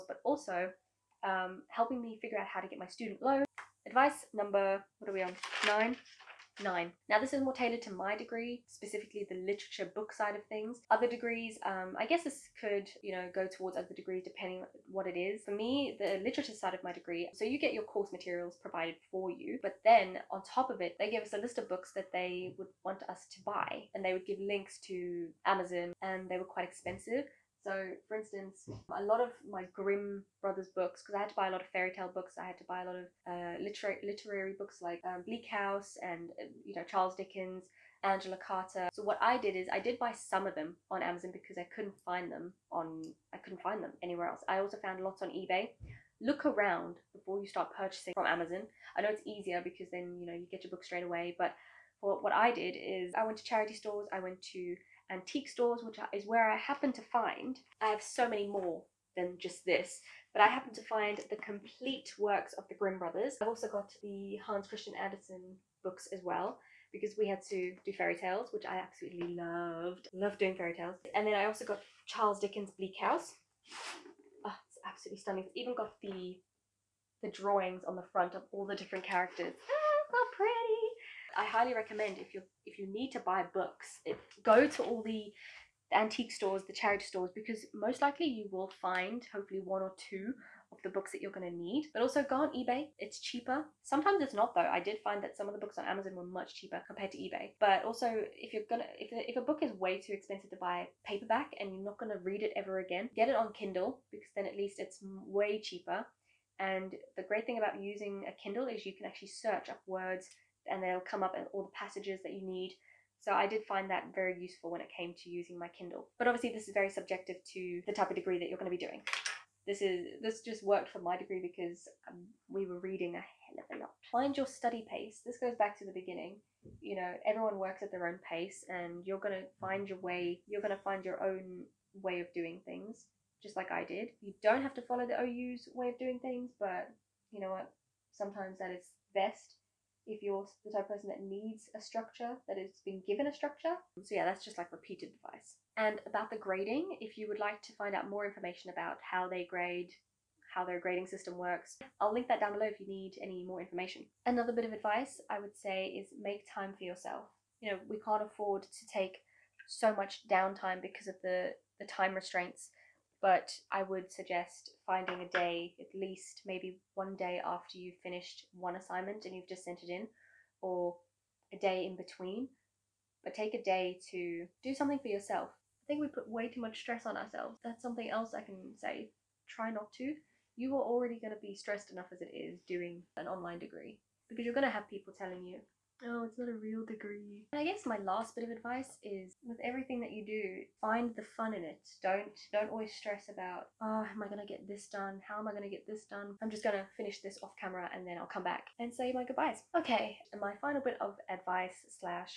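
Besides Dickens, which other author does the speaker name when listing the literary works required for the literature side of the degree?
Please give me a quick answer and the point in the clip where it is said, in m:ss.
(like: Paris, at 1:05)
Angela Carter, at 0:38.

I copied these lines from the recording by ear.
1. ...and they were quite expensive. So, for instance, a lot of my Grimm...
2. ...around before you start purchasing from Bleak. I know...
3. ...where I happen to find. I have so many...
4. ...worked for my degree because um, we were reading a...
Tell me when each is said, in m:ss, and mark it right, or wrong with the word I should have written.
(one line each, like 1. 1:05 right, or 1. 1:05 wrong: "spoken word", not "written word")
1. 0:26 right
2. 0:46 wrong: "Amazon", not "Bleak"
3. 0:56 right
4. 2:00 right.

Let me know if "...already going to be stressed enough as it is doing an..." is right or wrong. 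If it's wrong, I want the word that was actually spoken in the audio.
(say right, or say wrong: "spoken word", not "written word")
right.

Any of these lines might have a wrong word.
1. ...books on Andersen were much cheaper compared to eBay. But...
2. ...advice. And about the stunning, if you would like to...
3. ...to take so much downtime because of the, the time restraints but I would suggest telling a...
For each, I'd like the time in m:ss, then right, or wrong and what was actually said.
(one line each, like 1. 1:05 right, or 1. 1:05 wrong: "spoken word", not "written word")
1. 1:35 wrong: "Amazon", not "Andersen"
2. 2:25 wrong: "grading", not "stunning"
3. 2:38 wrong: "finding", not "telling".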